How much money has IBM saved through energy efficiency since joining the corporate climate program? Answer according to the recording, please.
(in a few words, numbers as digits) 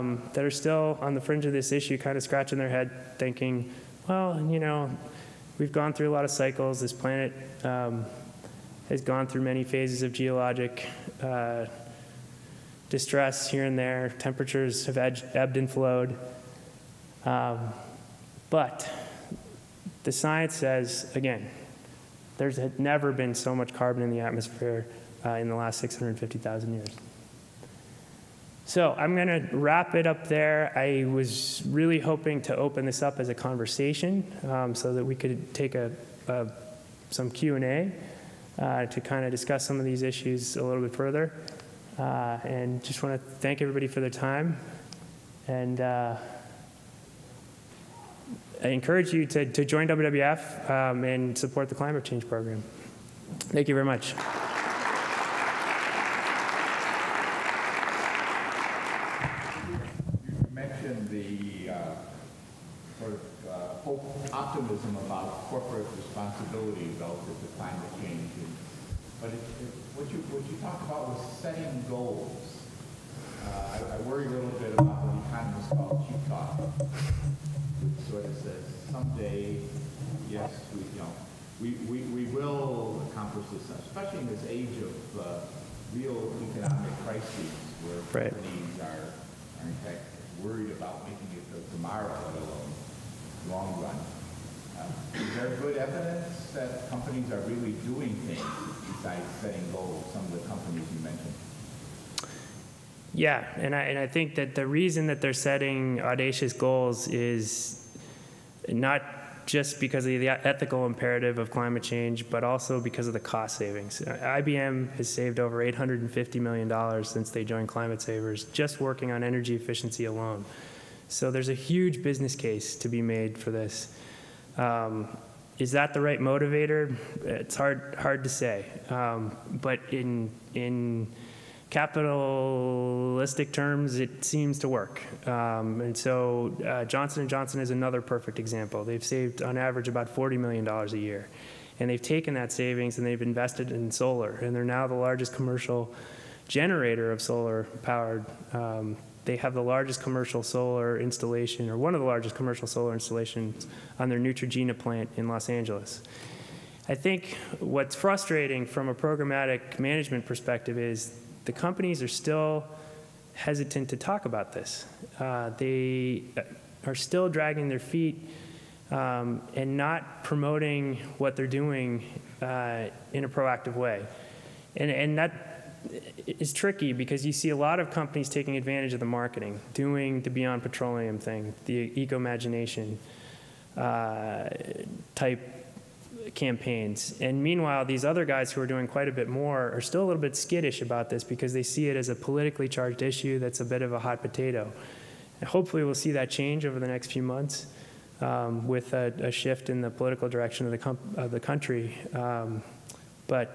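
$850 million.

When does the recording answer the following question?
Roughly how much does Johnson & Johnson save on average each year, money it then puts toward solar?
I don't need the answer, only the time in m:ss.
2:20.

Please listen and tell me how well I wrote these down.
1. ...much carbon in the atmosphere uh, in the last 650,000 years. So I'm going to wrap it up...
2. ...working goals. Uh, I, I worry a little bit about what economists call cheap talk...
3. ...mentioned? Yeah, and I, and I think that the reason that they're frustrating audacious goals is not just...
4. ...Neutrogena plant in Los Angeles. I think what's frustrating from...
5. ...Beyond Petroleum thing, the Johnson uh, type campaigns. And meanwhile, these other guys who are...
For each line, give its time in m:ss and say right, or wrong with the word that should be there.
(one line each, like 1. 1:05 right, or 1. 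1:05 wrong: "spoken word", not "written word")
1. 0:23 right
2. 1:11 wrong: "setting", not "working"
3. 1:41 wrong: "setting", not "frustrating"
4. 2:34 right
5. 3:00 wrong: "Ecomagination", not "Johnson".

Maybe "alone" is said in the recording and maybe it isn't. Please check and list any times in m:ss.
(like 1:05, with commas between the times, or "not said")
1:32, 2:00.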